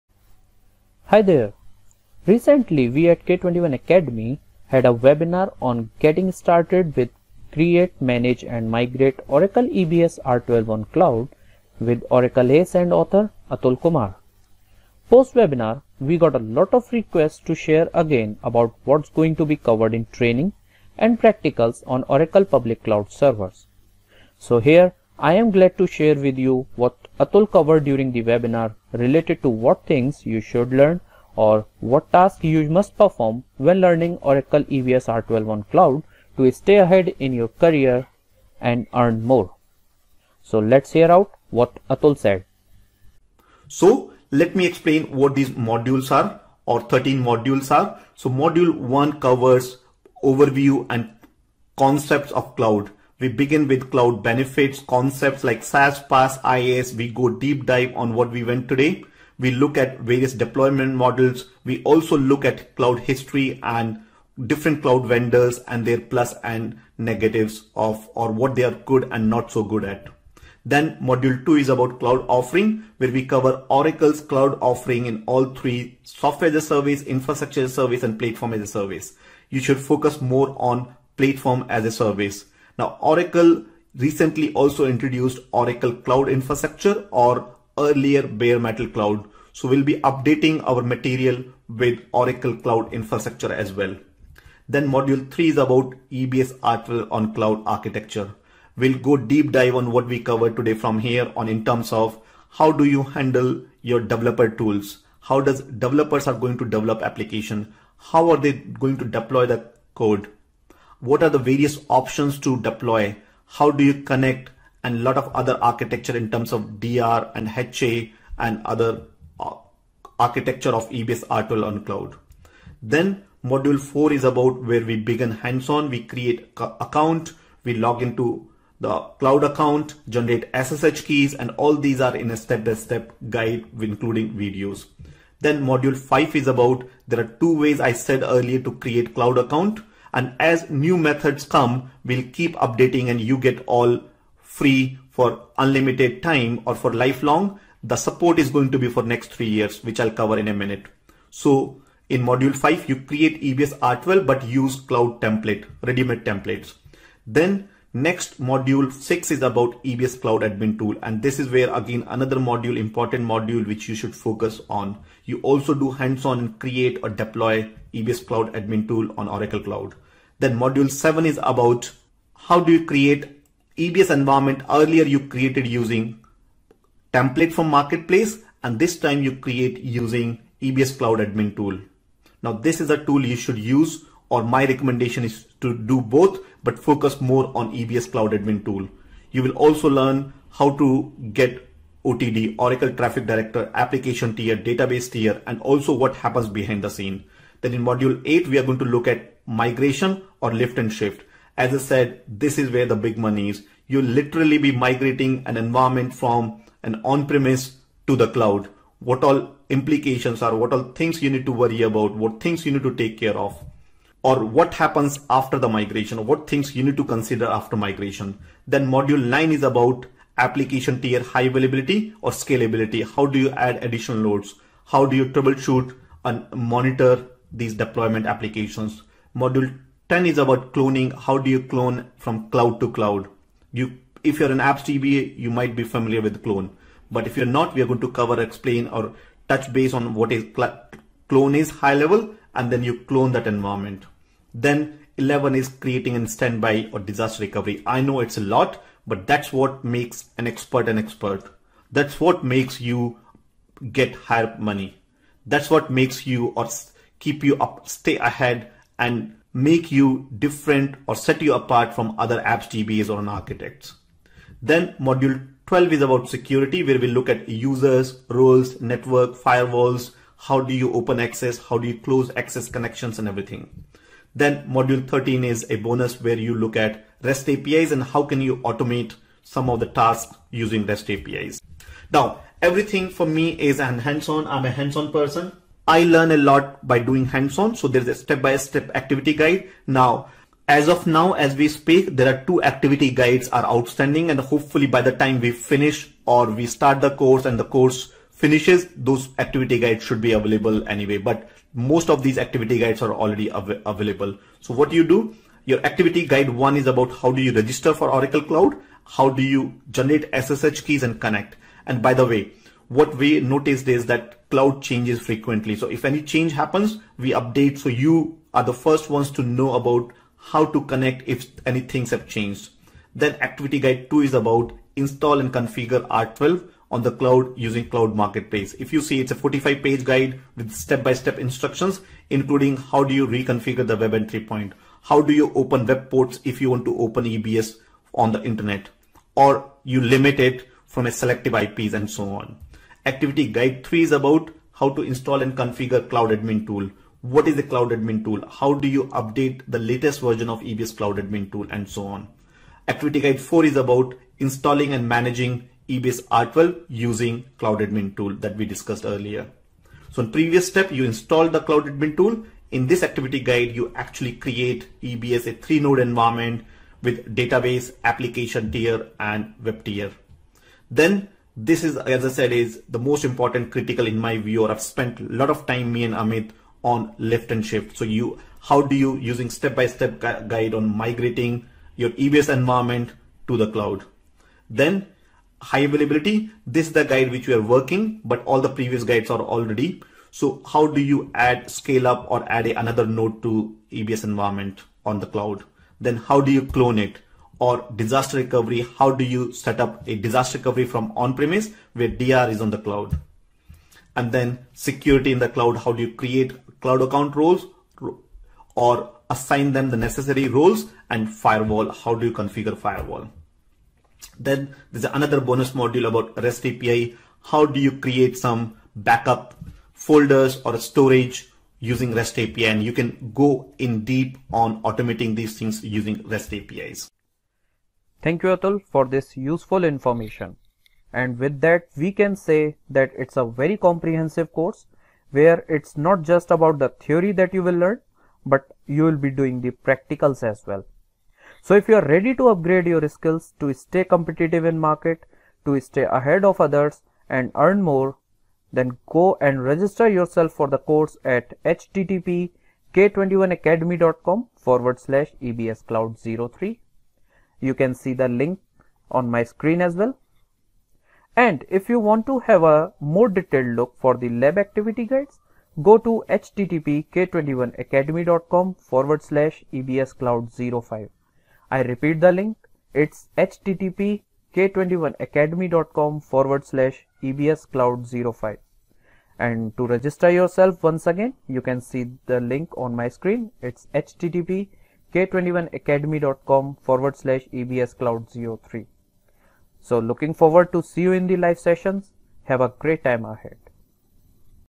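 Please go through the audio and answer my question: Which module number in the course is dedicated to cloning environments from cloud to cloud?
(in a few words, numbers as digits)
10.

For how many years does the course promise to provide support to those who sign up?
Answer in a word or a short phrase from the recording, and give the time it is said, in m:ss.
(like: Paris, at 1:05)
3, at 2:29.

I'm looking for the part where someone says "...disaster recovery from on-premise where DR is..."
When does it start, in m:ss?
6:40.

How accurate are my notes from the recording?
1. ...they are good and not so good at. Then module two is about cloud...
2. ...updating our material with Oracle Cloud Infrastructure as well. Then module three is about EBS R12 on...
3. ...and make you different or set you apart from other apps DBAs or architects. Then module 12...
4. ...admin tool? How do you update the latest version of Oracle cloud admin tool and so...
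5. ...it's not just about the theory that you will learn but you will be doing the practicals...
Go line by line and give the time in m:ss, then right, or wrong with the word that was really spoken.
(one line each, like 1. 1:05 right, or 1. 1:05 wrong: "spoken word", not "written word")
1. 1:08 right
2. 1:30 right
3. 4:19 right
4. 5:47 wrong: "EBS", not "Oracle"
5. 7:15 right.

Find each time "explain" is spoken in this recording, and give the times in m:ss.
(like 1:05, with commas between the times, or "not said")
0:44, 3:58.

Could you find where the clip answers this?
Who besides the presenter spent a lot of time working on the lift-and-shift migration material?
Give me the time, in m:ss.
6:16.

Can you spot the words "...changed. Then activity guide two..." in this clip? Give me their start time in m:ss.
5:22.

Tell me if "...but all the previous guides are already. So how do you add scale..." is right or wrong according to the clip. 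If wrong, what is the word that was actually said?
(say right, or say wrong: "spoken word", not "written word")
right.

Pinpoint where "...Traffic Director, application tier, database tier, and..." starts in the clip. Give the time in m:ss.
3:12.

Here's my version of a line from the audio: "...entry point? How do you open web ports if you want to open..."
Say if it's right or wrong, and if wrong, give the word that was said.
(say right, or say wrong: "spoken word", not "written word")
right.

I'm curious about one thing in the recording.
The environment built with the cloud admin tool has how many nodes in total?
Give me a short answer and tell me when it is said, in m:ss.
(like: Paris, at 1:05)
3, at 6:05.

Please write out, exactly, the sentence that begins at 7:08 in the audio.
Thank you Atul for this useful information.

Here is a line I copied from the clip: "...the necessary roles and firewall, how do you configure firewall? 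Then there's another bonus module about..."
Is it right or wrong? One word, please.
right.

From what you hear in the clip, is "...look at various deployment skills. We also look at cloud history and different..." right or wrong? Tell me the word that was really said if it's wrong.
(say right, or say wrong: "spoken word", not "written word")
wrong: "models", not "skills".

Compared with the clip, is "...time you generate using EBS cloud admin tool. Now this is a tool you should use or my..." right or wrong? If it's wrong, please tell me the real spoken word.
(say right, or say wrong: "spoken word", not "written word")
wrong: "create", not "generate".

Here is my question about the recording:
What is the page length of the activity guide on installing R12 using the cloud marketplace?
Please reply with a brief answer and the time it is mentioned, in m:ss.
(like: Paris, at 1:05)
45, at 5:29.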